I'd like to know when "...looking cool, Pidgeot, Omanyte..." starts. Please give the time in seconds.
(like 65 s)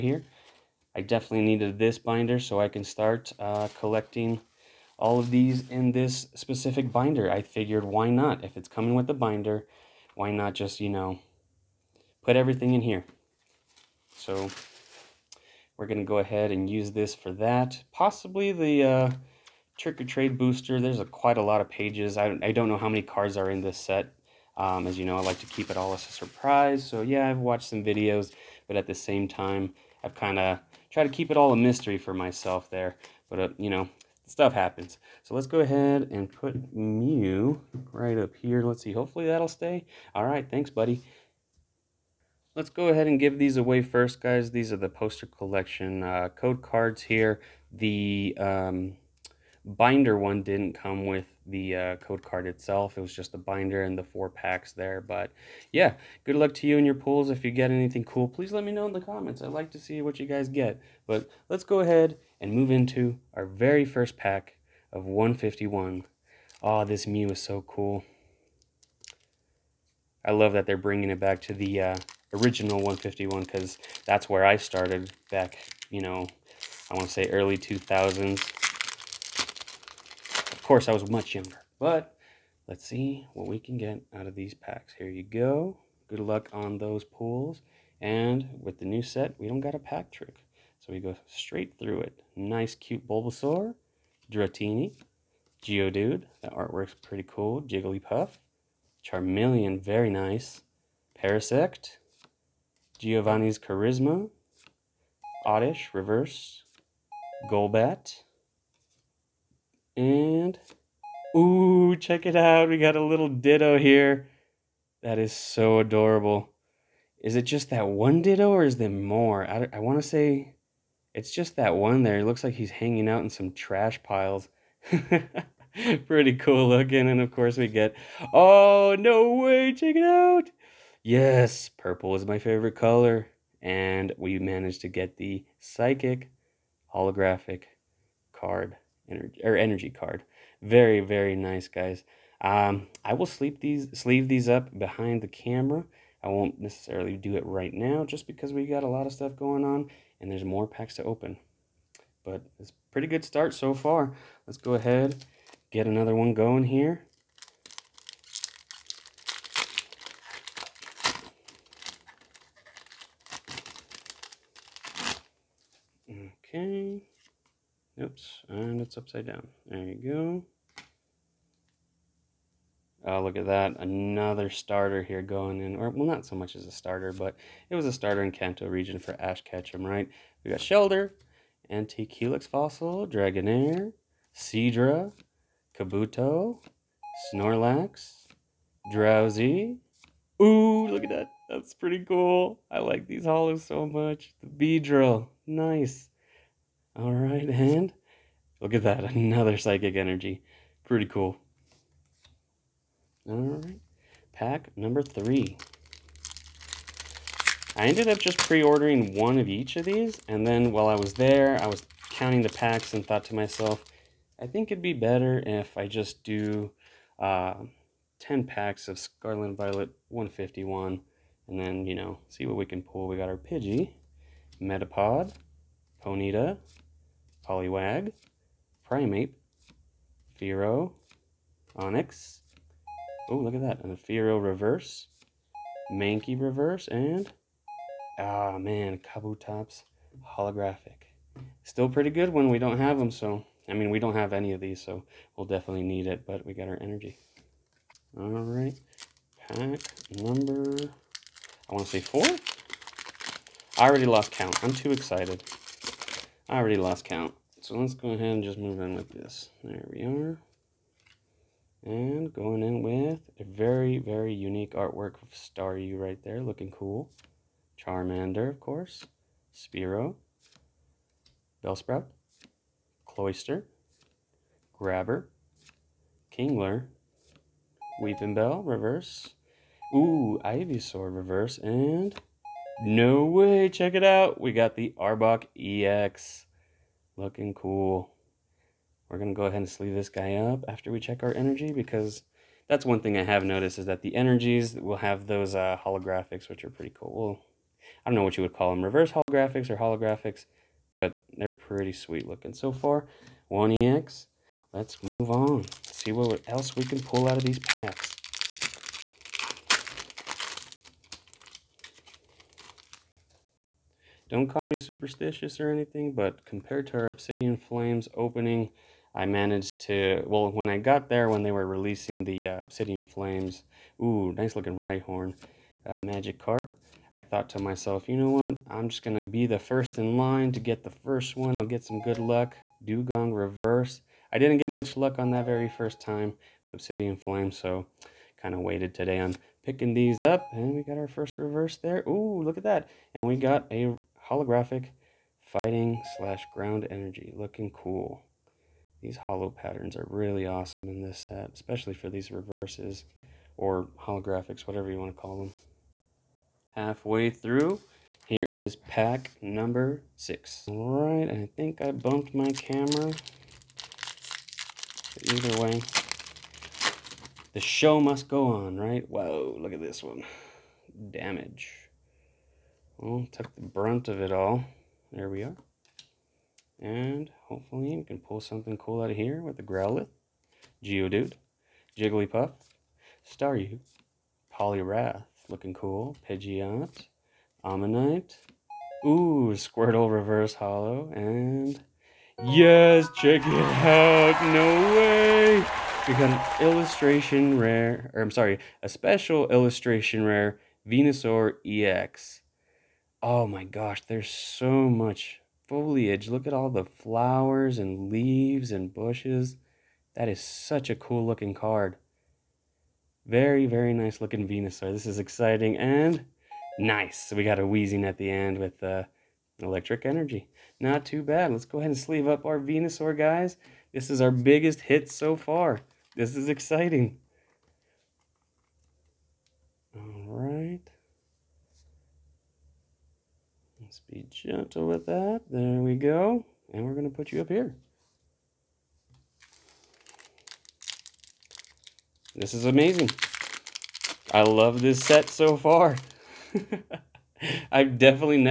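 385 s.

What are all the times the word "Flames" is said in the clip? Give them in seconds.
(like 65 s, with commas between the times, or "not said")
317 s, 323 s, 337 s.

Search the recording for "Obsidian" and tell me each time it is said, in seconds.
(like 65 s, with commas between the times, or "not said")
317 s, 322 s, 336 s.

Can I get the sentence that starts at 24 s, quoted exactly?
Um, as you know, I like to keep it all as a surprise.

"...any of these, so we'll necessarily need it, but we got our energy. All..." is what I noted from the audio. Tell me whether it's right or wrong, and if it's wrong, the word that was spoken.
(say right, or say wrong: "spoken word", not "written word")
wrong: "definitely", not "necessarily".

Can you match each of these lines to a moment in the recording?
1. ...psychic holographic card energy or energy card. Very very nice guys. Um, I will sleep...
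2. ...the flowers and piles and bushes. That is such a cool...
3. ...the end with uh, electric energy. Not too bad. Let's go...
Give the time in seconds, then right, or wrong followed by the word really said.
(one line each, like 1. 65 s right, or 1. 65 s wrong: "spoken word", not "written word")
1. 135 s right
2. 406 s wrong: "leaves", not "piles"
3. 418 s right.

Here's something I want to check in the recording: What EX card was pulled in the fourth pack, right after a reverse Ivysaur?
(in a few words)
Arbok EX.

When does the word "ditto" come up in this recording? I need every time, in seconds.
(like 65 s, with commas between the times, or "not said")
113 s, 118 s.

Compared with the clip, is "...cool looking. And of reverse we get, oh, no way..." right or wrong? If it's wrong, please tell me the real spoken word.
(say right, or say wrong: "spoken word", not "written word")
wrong: "course", not "reverse".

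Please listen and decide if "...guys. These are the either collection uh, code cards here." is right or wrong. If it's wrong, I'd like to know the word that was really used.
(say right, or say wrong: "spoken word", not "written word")
wrong: "poster", not "either".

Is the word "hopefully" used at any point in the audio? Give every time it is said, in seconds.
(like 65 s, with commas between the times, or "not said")
38 s, 377 s.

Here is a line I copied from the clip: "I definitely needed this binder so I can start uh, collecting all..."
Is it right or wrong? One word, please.
right.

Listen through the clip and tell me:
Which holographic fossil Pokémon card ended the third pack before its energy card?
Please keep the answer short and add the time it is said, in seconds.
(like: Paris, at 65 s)
Kabutops, at 238 s.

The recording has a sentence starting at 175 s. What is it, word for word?
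Or, well, not so much as a starter, but it was a starter in Kanto region for Ash Ketchum, right?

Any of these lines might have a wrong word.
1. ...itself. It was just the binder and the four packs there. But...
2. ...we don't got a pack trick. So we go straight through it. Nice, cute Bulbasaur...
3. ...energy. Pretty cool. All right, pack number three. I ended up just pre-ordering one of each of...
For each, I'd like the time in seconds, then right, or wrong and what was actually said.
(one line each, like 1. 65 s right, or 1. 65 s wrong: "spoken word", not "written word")
1. 52 s right
2. 89 s right
3. 199 s right.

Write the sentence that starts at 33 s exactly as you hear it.
But uh, you know, stuff happens.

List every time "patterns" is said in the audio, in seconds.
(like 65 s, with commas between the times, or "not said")
349 s.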